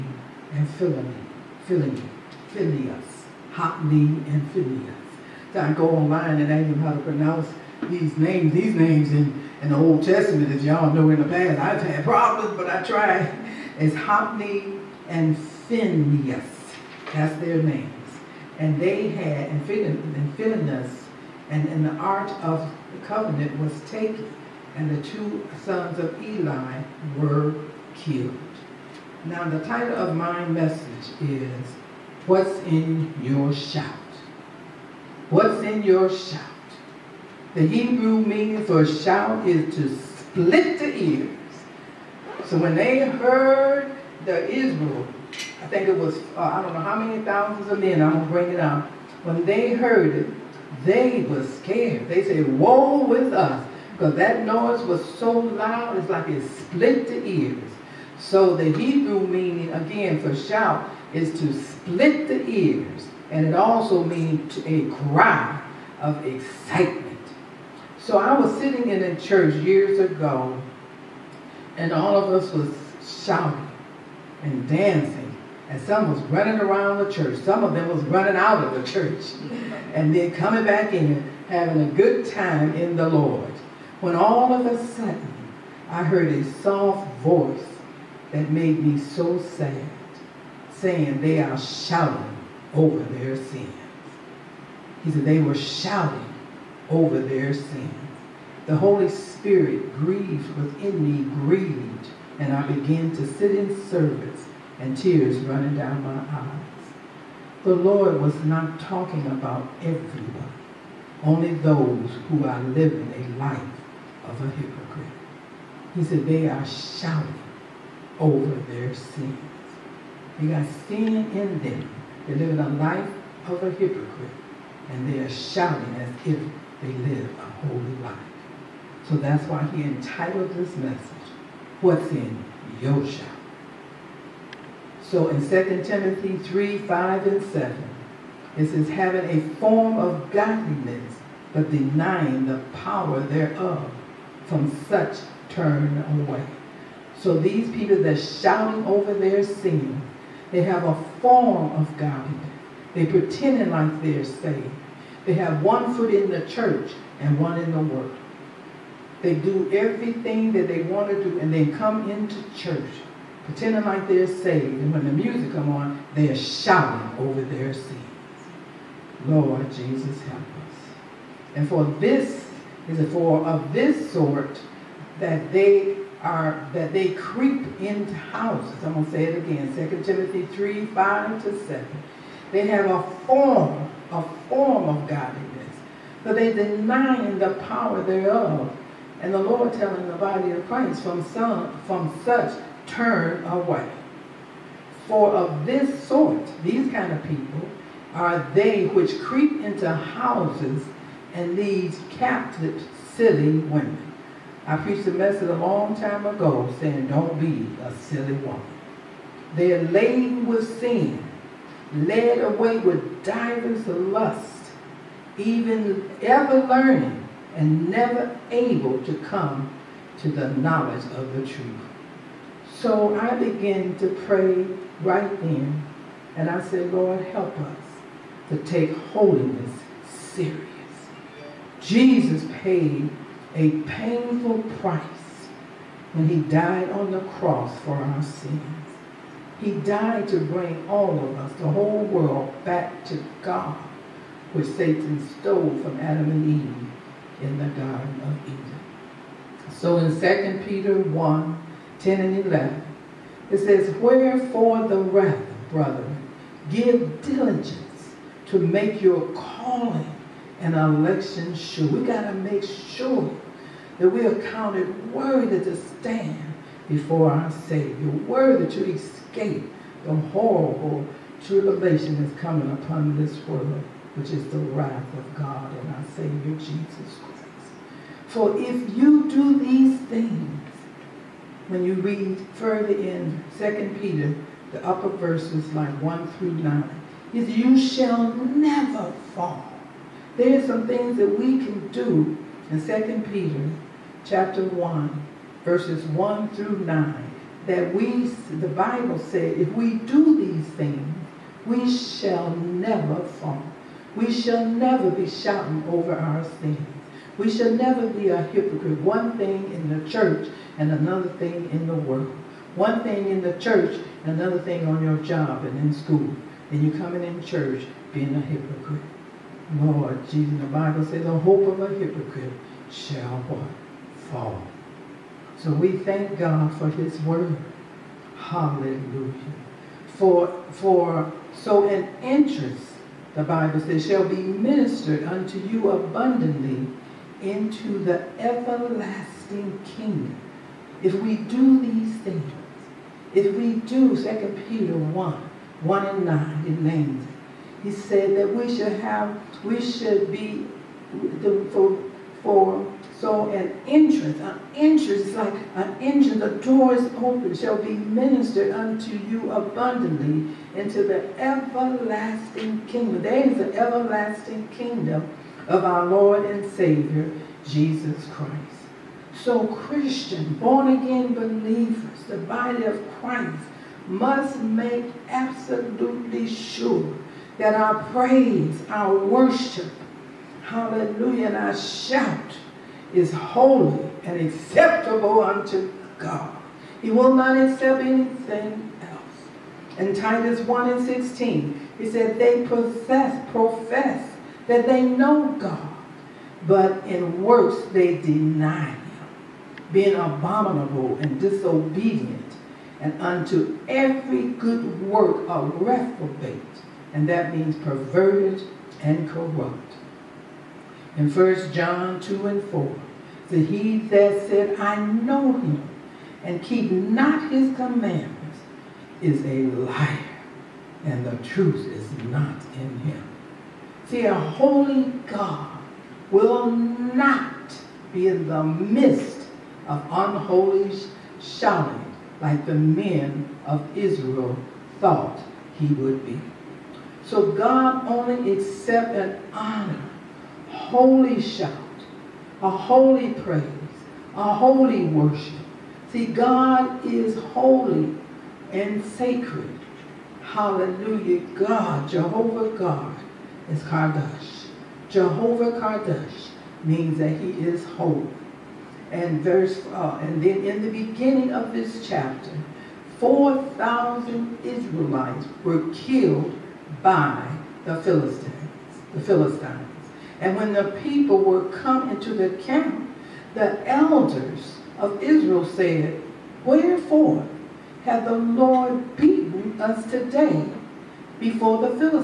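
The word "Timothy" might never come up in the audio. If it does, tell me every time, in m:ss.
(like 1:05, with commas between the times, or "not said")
2:15, 3:00.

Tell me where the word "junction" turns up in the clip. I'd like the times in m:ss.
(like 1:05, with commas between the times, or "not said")
not said.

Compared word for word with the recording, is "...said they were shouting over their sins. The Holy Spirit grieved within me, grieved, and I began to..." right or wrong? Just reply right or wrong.
right.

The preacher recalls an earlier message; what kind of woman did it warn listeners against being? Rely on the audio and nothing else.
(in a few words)
a silly woman.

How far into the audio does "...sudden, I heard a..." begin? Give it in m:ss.
1:24.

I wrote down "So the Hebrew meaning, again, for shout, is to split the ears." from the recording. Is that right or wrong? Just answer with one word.
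right.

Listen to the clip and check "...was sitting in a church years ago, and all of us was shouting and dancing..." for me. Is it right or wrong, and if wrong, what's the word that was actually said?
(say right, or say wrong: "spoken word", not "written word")
right.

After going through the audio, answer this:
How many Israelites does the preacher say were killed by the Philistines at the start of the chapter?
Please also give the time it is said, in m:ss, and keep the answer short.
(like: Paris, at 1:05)
4,000, at 7:43.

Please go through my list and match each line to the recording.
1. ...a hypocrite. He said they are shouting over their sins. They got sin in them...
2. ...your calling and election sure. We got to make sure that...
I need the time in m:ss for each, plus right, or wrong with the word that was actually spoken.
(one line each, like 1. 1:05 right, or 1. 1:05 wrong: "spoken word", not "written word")
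1. 1:54 right
2. 4:19 right.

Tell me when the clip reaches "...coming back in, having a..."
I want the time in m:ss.
1:20.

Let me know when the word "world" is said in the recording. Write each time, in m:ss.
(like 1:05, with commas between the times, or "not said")
2:37, 4:02, 4:33, 5:11.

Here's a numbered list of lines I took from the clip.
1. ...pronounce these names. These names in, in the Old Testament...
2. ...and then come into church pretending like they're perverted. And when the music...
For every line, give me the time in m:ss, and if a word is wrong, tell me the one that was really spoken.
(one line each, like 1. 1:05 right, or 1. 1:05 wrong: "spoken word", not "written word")
1. 0:06 right
2. 2:41 wrong: "saved", not "perverted".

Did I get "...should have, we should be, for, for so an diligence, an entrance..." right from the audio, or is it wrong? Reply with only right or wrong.
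wrong.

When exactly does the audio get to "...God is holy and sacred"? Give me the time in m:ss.
7:26.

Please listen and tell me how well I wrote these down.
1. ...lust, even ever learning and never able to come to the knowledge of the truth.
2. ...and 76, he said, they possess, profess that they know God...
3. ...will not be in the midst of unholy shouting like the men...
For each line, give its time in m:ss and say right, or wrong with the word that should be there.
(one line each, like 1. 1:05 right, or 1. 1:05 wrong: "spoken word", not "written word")
1. 3:33 right
2. 6:30 wrong: "16", not "76"
3. 7:06 right.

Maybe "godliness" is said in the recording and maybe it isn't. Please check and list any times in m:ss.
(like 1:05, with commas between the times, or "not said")
2:20, 3:05.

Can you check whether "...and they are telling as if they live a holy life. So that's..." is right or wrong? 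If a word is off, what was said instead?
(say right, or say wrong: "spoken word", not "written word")
wrong: "shouting", not "telling".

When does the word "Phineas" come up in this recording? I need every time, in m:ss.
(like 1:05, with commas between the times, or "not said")
0:15, 0:19.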